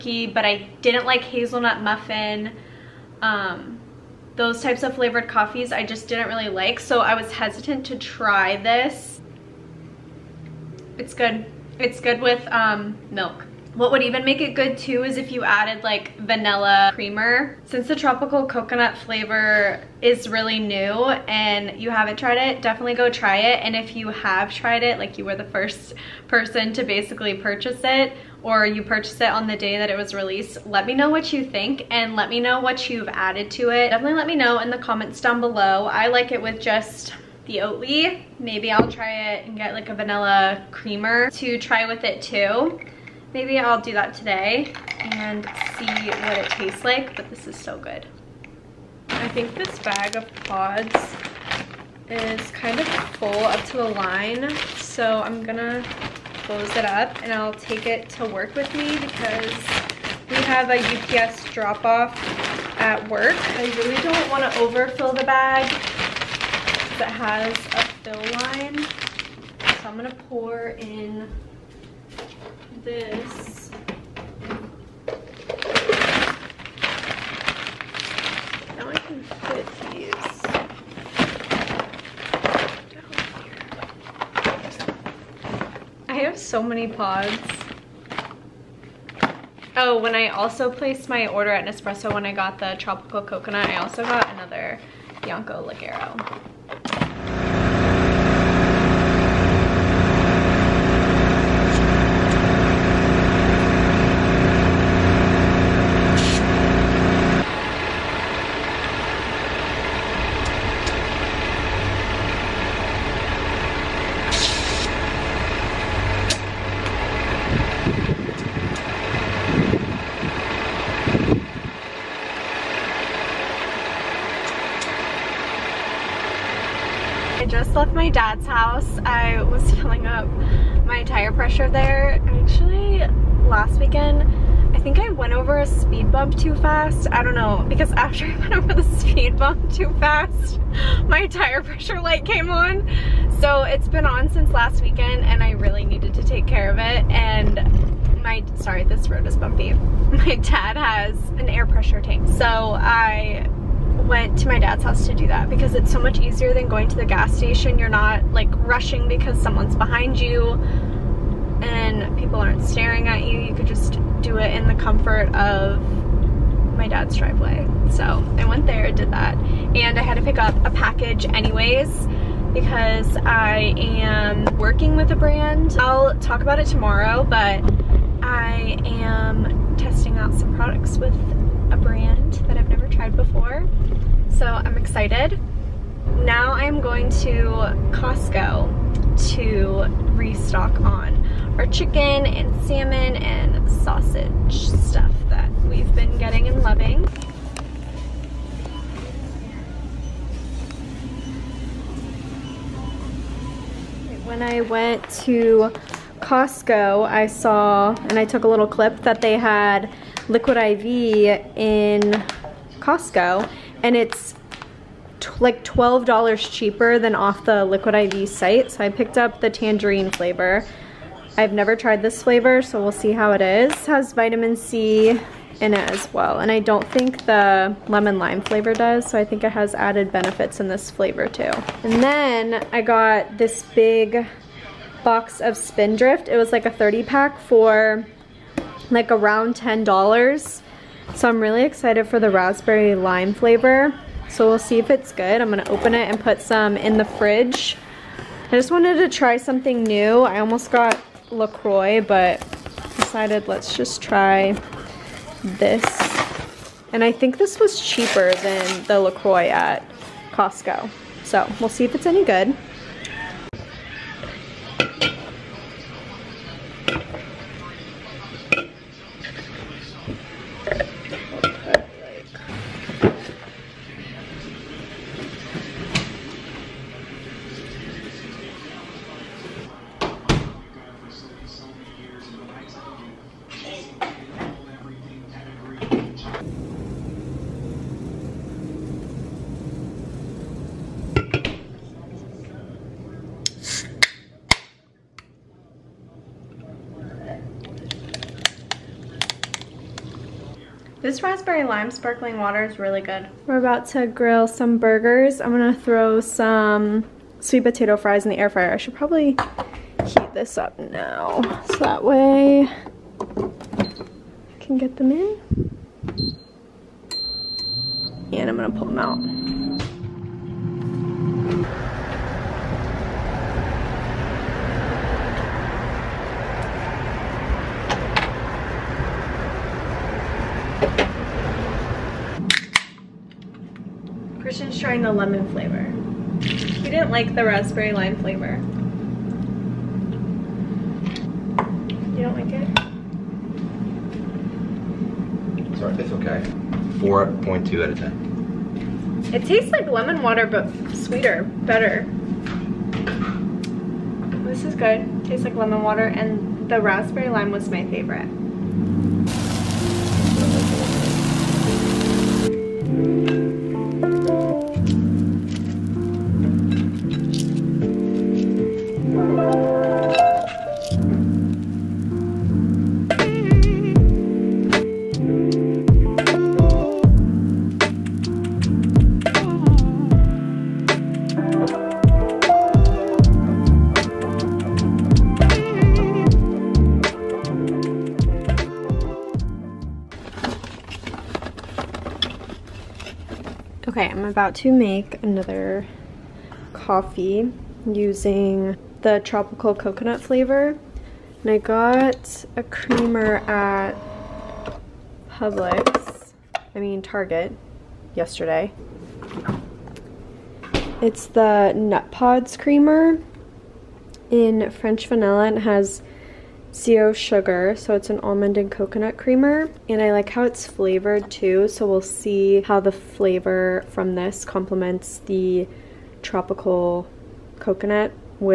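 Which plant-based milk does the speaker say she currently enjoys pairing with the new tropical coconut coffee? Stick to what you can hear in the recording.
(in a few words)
Oatly.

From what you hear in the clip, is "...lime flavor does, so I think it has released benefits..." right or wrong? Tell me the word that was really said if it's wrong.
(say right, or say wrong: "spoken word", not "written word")
wrong: "added", not "released".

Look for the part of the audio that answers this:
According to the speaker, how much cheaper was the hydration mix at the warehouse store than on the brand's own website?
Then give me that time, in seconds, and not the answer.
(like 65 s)
215 s.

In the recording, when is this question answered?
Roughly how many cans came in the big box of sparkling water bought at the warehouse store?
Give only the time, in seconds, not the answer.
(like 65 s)
236 s.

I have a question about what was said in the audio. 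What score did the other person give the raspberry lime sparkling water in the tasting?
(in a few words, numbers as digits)
4.2 out of 10.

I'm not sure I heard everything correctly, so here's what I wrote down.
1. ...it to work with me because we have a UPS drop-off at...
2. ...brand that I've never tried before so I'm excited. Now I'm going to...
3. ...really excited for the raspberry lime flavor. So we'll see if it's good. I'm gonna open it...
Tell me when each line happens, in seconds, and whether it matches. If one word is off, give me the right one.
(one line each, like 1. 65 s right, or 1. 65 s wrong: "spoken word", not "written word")
1. 57 s right
2. 181 s right
3. 241 s right.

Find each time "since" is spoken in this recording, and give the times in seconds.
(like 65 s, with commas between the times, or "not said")
17 s, 144 s.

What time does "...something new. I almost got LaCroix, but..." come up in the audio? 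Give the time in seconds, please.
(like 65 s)
249 s.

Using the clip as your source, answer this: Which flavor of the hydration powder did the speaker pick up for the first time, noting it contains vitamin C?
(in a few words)
tangerine.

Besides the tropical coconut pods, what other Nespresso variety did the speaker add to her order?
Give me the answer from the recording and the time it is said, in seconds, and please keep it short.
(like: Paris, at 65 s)
Bianco Leggero, at 95 s.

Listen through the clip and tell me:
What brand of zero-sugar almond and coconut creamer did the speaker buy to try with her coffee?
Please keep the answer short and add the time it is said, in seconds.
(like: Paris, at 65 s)
Nutpods, at 411 s.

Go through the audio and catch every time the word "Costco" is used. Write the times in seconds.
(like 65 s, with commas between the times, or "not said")
187 s, 206 s, 212 s, 260 s.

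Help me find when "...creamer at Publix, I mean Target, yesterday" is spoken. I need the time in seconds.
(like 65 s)
402 s.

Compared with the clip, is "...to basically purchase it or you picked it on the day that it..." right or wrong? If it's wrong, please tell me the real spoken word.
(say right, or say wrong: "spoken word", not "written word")
wrong: "purchased", not "picked".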